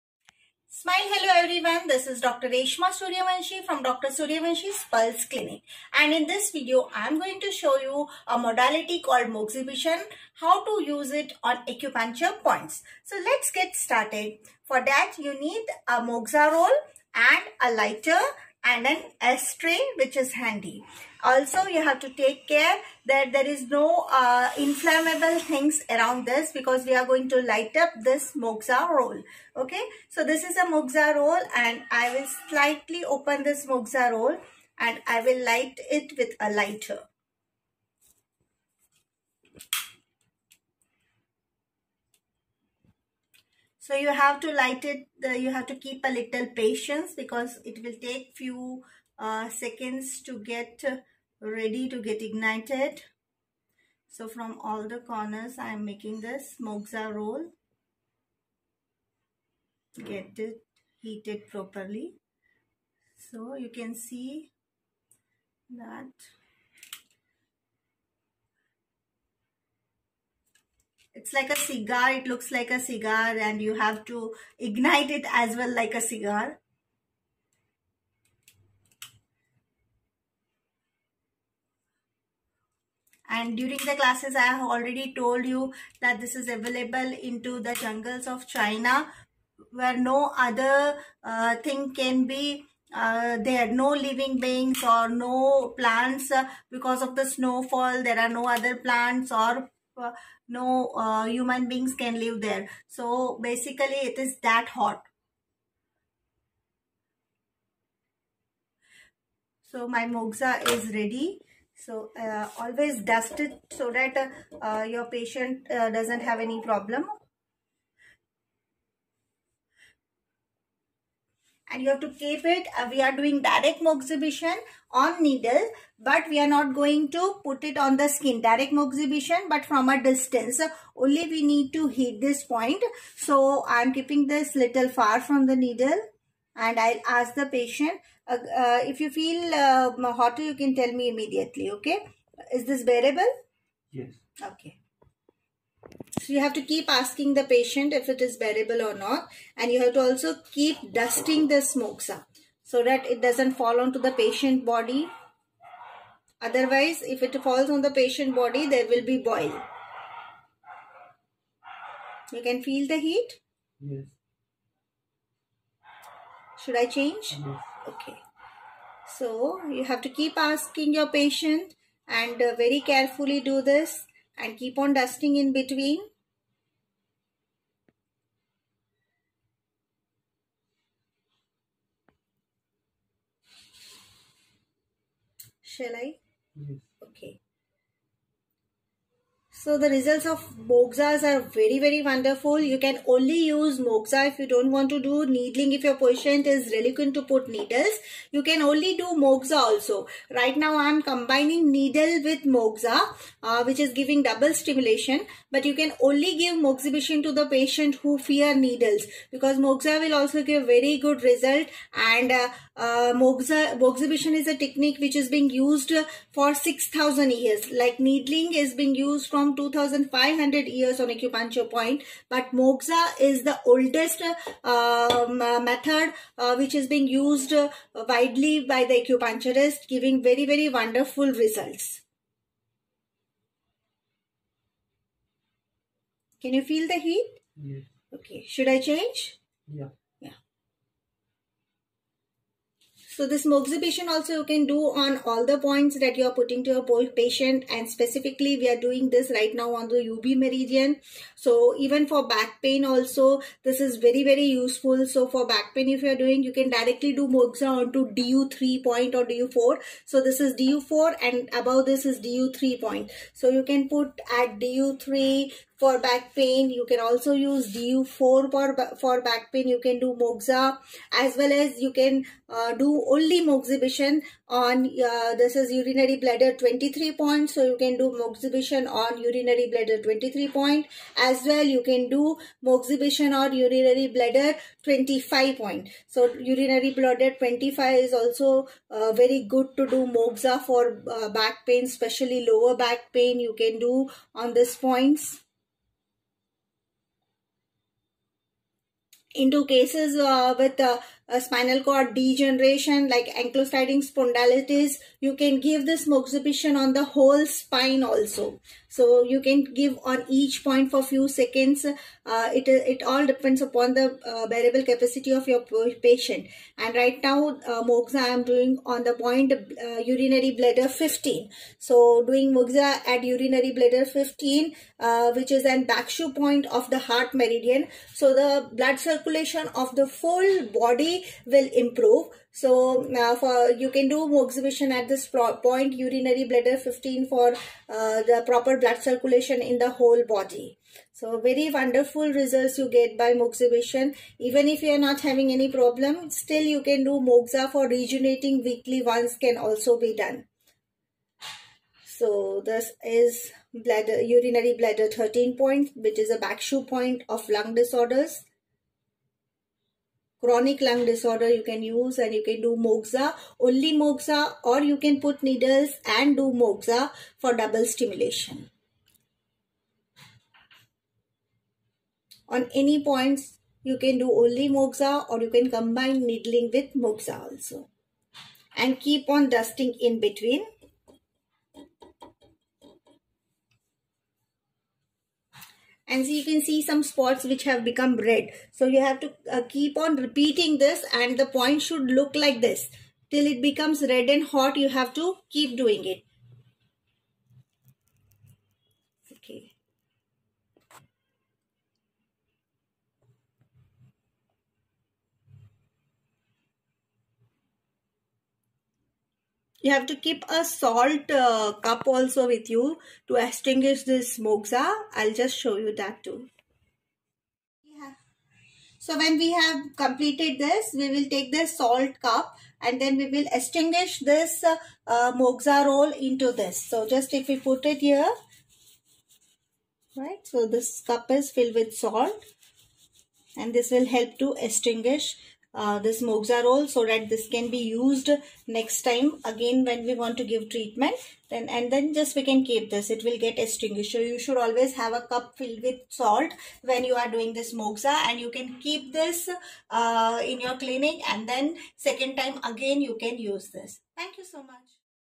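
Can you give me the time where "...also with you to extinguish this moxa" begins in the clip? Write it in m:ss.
6:52.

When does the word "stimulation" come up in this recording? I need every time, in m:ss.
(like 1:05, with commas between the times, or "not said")
3:24, 6:07.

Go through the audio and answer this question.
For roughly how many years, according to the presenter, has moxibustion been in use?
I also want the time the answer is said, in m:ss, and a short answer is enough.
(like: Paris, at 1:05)
6000 years, at 3:36.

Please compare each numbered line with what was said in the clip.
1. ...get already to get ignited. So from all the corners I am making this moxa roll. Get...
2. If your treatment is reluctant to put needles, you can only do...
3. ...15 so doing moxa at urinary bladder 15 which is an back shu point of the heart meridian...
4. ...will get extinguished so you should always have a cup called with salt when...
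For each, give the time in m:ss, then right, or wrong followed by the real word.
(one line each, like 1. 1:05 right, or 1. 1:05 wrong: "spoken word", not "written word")
1. 0:50 wrong: "ready", not "already"
2. 3:15 wrong: "patient", not "treatment"
3. 5:20 right
4. 7:23 wrong: "filled", not "called".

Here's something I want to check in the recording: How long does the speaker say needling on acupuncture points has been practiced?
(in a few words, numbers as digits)
2500 years.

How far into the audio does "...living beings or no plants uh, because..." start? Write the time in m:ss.
1:33.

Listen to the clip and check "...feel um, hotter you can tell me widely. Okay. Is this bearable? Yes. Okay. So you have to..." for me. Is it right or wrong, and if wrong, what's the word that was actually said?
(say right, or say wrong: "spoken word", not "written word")
wrong: "immediately", not "widely".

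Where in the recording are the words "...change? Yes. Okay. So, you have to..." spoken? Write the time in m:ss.
2:46.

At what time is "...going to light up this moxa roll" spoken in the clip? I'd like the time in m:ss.
0:27.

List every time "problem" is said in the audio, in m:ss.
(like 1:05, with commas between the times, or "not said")
1:56, 5:45.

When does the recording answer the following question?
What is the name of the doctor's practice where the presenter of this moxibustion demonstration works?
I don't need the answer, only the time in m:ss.
0:03.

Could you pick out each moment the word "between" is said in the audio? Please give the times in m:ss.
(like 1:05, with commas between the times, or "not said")
2:55, 6:20.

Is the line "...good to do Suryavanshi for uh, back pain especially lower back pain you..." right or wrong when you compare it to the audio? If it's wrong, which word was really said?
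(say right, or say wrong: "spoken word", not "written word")
wrong: "Moxa", not "Suryavanshi".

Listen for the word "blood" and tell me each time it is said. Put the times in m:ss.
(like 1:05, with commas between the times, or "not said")
5:28, 5:38.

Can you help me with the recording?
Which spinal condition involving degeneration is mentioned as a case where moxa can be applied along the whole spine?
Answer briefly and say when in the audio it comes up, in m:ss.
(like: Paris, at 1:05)
Ankylosing spondylitis, at 5:03.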